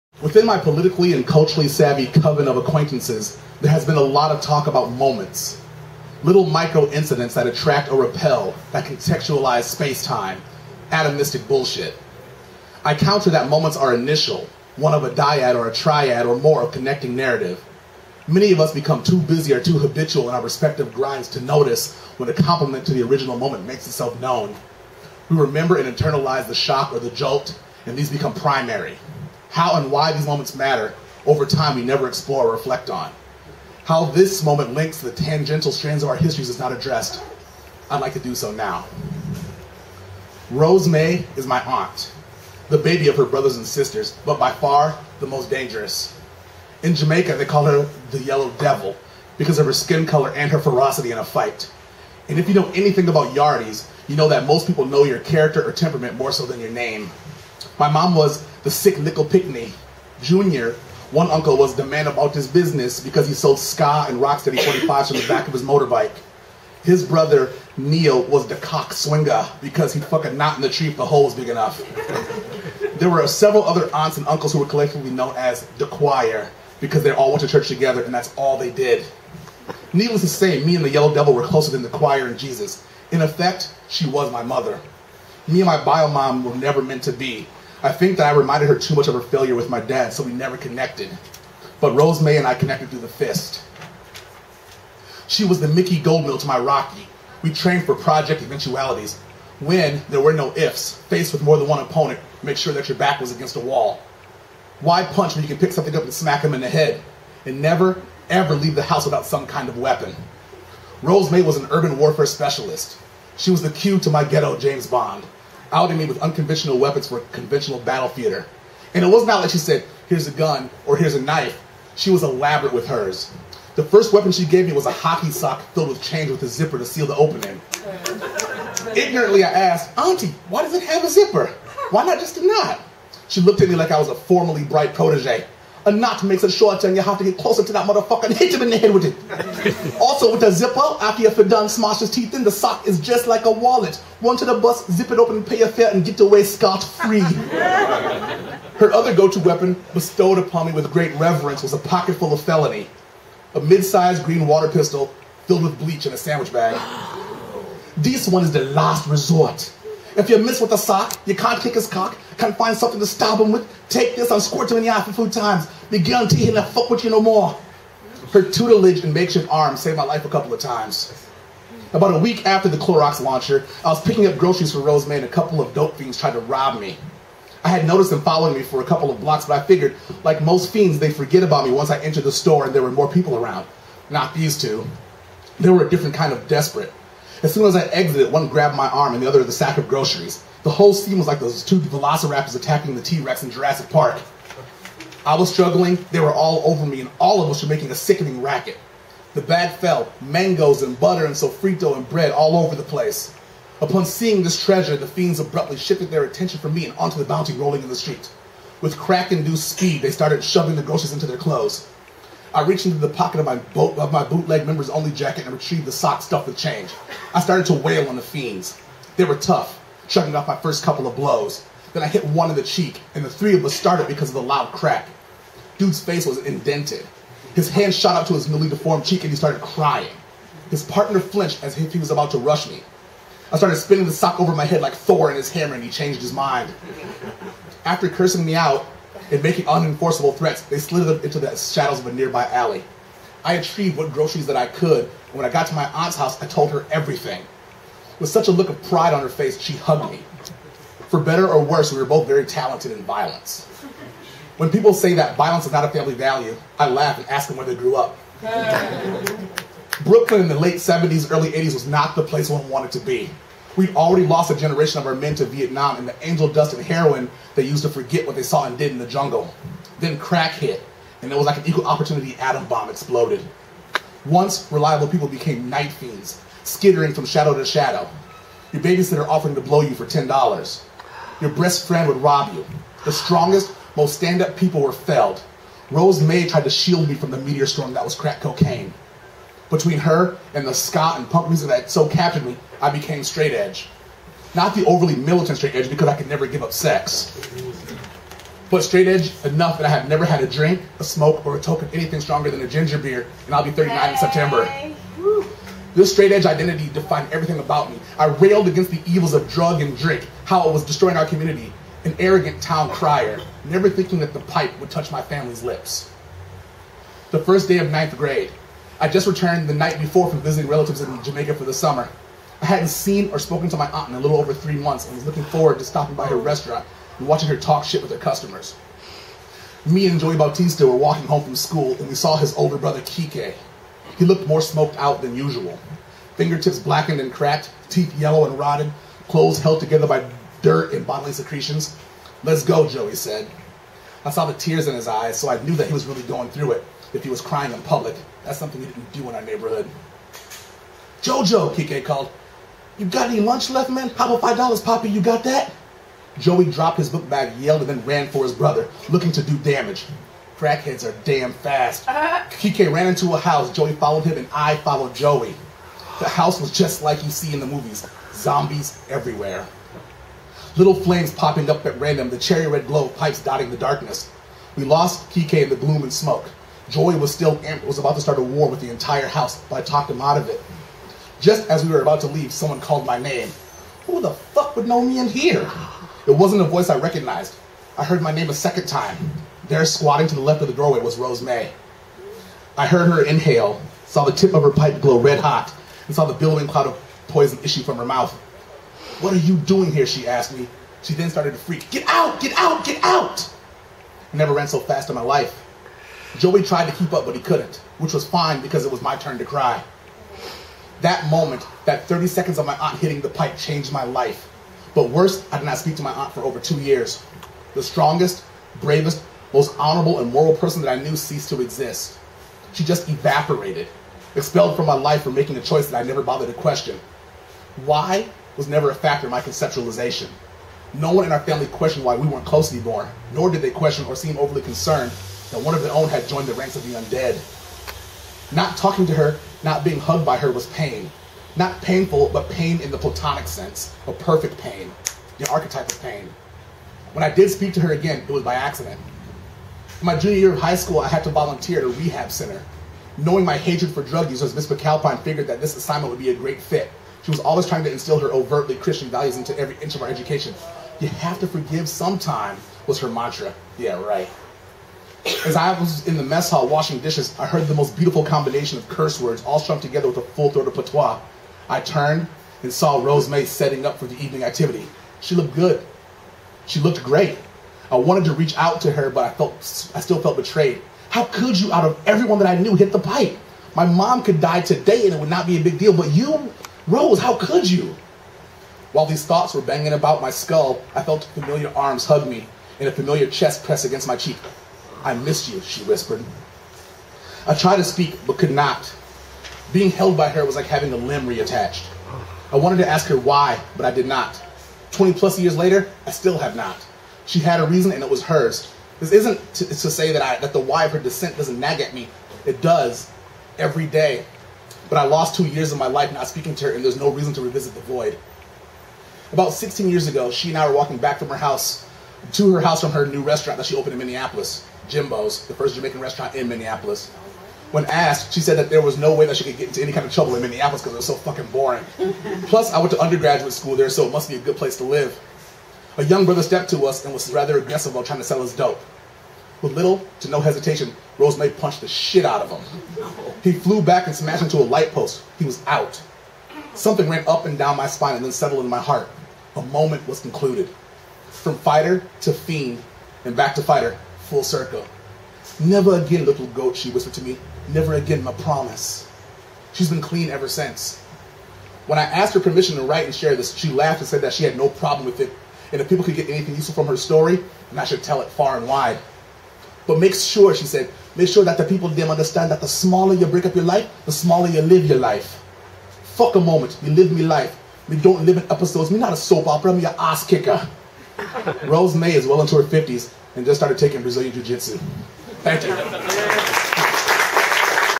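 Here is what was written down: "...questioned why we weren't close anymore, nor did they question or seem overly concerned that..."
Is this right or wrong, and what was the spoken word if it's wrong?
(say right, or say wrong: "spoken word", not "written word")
right.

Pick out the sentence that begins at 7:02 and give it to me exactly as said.
She just evaporated, expelled from my life for making a choice that I never bothered to question.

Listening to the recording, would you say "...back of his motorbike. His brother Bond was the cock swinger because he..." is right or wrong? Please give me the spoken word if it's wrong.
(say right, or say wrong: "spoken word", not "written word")
wrong: "Neil", not "Bond".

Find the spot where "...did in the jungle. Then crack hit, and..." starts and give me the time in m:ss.
4:28.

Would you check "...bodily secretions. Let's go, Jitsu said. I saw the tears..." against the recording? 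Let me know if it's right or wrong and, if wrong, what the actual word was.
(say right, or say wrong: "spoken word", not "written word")
wrong: "Joey", not "Jitsu".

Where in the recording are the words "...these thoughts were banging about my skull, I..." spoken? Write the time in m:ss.
8:09.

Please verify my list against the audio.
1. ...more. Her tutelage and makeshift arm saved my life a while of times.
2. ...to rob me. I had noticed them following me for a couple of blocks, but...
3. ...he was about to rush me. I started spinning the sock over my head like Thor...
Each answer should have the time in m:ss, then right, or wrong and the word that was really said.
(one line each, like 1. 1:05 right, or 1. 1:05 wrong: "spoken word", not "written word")
1. 2:47 wrong: "couple", not "while"
2. 2:56 right
3. 3:51 right.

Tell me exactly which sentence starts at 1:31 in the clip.
But Rose May and I connected through the fist.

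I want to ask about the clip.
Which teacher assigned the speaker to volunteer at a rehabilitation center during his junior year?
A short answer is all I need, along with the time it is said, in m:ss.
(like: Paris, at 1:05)
Miss McAlpine, at 7:34.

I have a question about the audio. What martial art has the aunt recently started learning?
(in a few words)
Brazilian Jiu Jitsu.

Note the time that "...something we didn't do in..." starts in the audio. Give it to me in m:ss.
5:48.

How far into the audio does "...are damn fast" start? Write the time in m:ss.
6:01.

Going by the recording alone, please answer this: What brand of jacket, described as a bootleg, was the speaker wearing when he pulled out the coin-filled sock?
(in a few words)
Members Only.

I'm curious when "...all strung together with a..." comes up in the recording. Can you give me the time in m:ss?
7:49.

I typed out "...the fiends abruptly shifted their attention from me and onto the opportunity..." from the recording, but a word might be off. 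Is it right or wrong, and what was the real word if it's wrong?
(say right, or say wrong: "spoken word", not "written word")
wrong: "bounty", not "opportunity".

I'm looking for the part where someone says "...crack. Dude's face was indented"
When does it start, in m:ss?
3:44.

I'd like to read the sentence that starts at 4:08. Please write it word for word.
With such a look of pride on her face, she hugged me.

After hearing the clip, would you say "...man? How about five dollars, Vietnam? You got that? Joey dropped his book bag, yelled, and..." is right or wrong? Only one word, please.
wrong.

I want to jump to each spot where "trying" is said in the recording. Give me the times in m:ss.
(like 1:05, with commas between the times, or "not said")
7:37, 8:58.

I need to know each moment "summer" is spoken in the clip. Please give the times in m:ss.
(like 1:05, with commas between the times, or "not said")
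5:21.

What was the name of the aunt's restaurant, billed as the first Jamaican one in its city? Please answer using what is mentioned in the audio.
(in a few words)
Jimbo's.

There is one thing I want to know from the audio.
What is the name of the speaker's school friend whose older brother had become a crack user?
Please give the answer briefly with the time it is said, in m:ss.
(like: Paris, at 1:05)
Joey Bautista, at 5:30.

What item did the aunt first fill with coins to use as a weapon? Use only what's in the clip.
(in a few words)
A hockey sock.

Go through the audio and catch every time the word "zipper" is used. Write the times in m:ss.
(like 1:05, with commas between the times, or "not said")
2:06, 2:11, 2:20.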